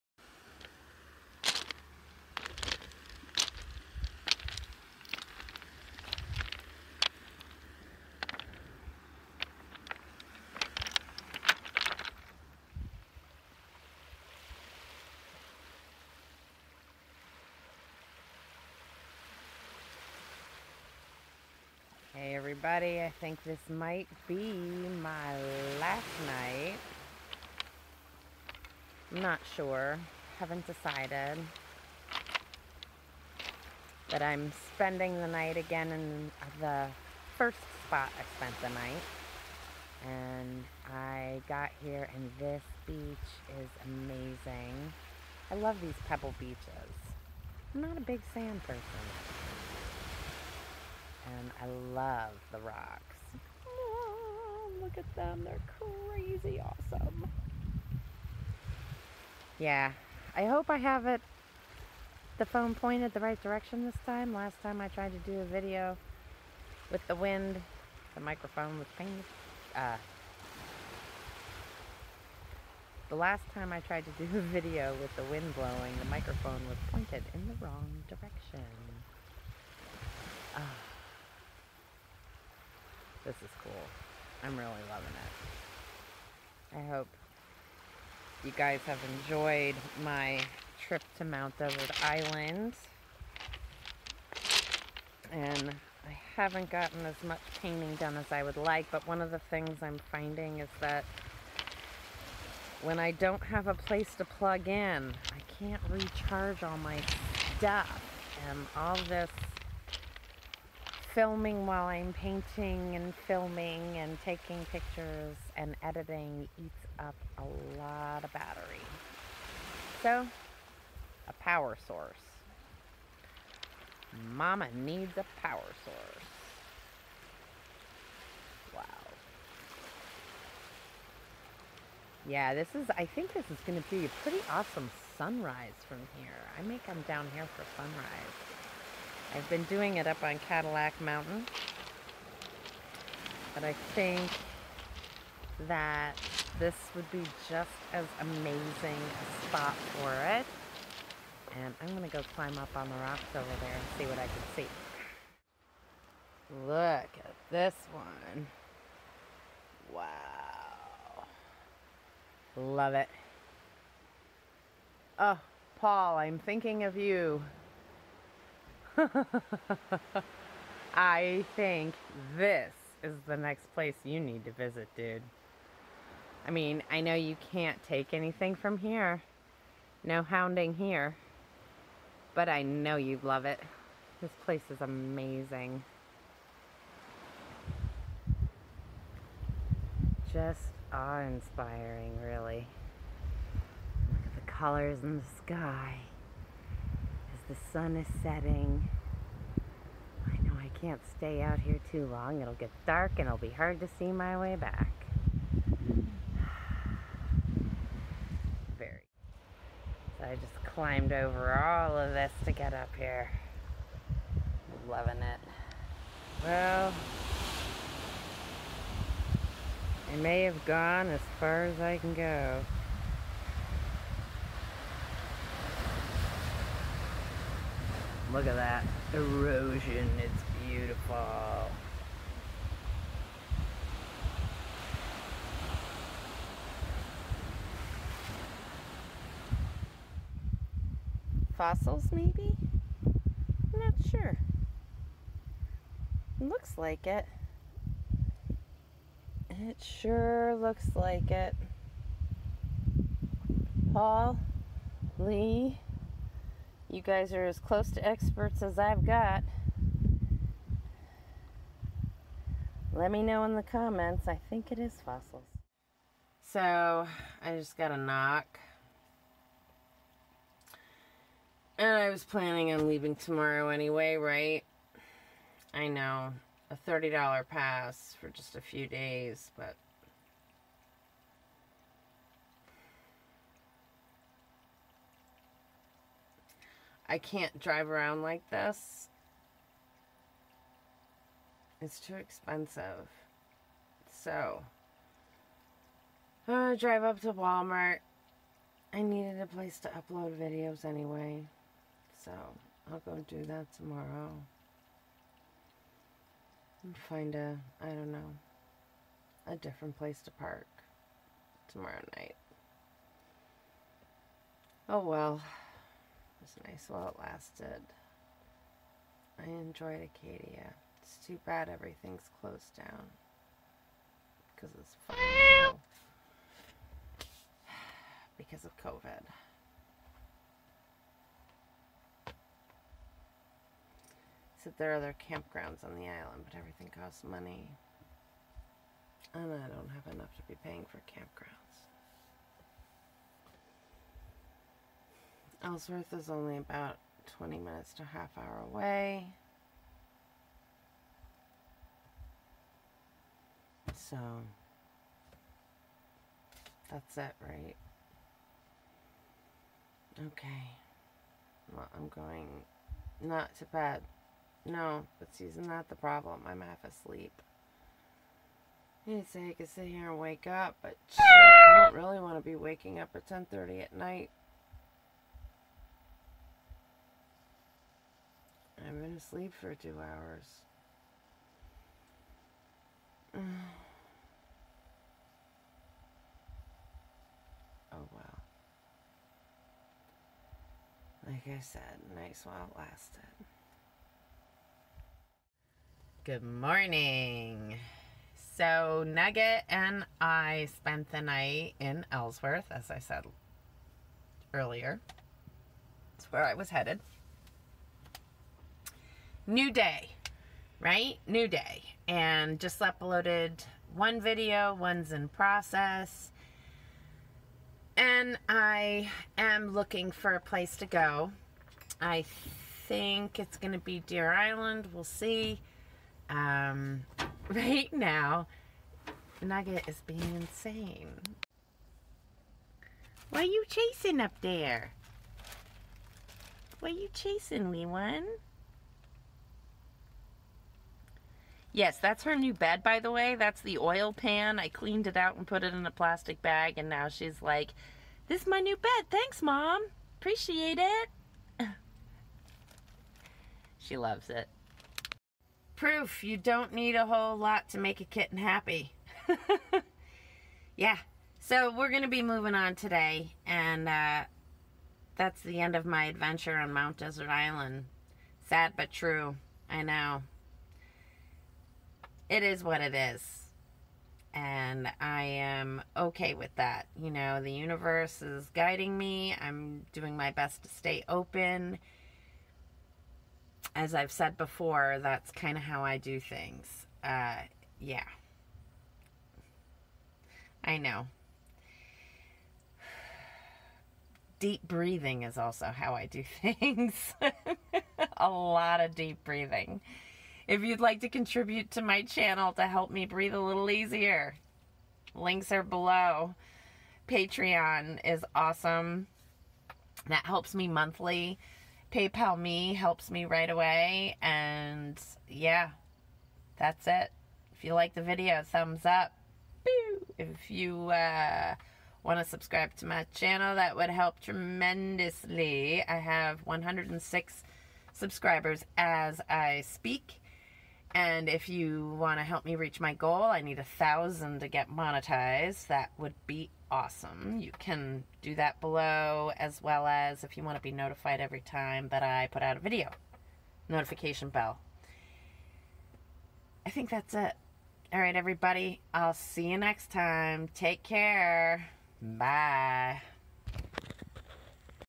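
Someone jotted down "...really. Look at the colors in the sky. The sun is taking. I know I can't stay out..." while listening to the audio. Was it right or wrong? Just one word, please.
wrong.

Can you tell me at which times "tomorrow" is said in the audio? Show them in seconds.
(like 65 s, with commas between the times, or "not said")
273 s, 303 s, 311 s.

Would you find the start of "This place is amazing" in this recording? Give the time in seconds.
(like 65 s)
184 s.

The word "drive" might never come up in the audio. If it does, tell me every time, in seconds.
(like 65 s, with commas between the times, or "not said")
287 s, 296 s.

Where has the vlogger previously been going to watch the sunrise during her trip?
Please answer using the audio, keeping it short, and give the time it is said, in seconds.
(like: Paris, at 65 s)
Cadillac Mountain, at 140 s.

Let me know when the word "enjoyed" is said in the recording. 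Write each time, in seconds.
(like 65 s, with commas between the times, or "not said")
89 s, 319 s.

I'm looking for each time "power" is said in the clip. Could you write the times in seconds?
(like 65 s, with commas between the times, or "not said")
121 s, 125 s.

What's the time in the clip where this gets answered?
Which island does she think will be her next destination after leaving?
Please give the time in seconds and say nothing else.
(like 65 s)
424 s.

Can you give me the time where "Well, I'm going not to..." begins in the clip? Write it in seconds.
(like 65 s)
361 s.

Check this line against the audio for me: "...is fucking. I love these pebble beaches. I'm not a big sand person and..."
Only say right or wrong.
wrong.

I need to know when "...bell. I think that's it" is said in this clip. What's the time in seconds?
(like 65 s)
544 s.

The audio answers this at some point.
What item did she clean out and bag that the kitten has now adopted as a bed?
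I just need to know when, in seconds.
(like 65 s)
443 s.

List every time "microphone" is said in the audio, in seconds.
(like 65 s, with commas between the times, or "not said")
68 s, 76 s.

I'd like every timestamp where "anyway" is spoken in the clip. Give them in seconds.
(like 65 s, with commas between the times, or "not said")
273 s, 300 s.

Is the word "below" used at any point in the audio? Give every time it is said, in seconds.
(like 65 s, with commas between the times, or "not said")
505 s, 538 s.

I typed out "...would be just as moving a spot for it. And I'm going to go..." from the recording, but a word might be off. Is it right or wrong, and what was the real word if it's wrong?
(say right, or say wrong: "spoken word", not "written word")
wrong: "amazing", not "moving".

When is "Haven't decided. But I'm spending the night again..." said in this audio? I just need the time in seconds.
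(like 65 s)
30 s.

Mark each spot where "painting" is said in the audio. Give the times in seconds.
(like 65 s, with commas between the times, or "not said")
97 s, 112 s.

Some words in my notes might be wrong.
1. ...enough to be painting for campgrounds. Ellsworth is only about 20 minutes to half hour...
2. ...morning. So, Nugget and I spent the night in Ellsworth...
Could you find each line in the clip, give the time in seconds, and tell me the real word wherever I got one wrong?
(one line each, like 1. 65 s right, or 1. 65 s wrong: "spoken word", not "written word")
1. 340 s wrong: "paying", not "painting"
2. 396 s right.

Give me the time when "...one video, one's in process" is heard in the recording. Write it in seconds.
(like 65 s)
413 s.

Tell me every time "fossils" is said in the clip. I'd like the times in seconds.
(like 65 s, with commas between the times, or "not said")
241 s, 265 s.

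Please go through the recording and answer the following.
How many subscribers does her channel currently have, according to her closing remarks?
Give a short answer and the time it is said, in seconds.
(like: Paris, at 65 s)
106, at 526 s.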